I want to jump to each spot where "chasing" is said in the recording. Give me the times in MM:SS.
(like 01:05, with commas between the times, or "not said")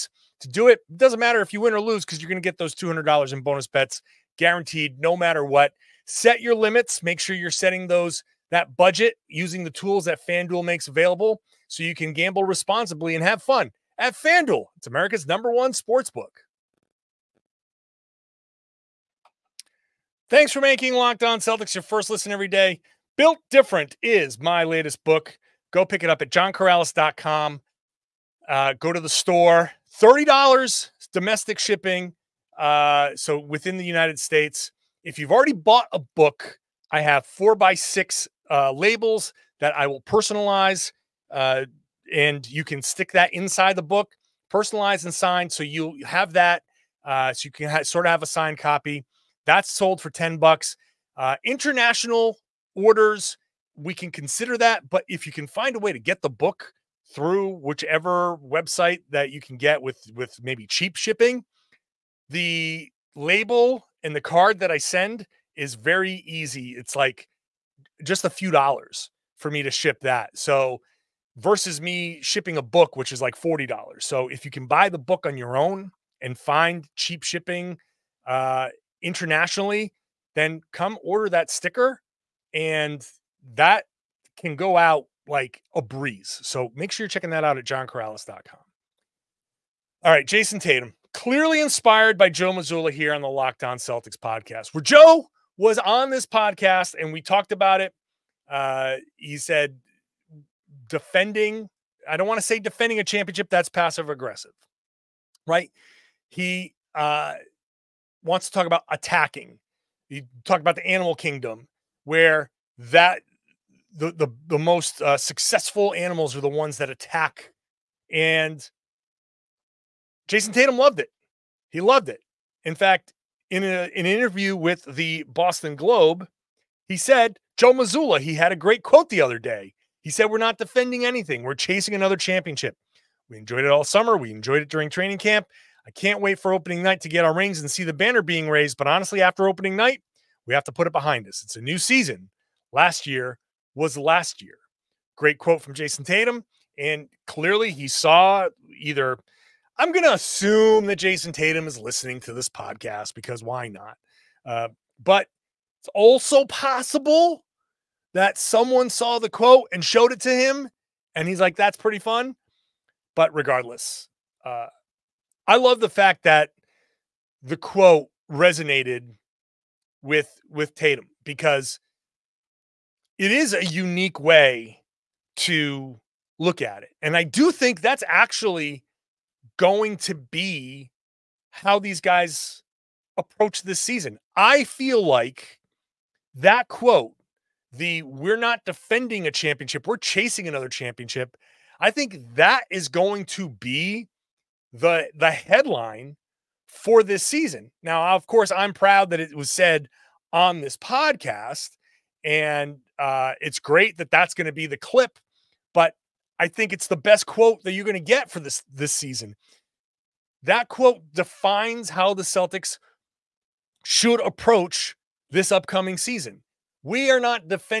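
02:11, 03:09.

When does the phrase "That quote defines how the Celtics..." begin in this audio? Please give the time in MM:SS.
03:30.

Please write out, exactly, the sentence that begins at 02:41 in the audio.
And he's like, that's pretty fun.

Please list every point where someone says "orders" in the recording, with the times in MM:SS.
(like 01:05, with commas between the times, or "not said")
00:52, 01:21.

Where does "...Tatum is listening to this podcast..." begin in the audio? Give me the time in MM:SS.
02:31.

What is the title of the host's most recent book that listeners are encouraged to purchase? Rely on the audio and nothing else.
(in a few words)
Built Different.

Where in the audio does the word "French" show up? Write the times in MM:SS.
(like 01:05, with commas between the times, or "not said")
not said.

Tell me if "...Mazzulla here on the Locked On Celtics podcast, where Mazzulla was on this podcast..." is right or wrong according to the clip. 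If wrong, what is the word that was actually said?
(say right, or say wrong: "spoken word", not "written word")
wrong: "Joe", not "Mazzulla".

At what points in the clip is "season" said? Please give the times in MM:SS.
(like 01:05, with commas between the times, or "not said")
02:21, 03:03, 03:17, 03:28, 03:35.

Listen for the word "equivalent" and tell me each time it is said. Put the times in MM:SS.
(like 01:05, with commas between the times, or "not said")
not said.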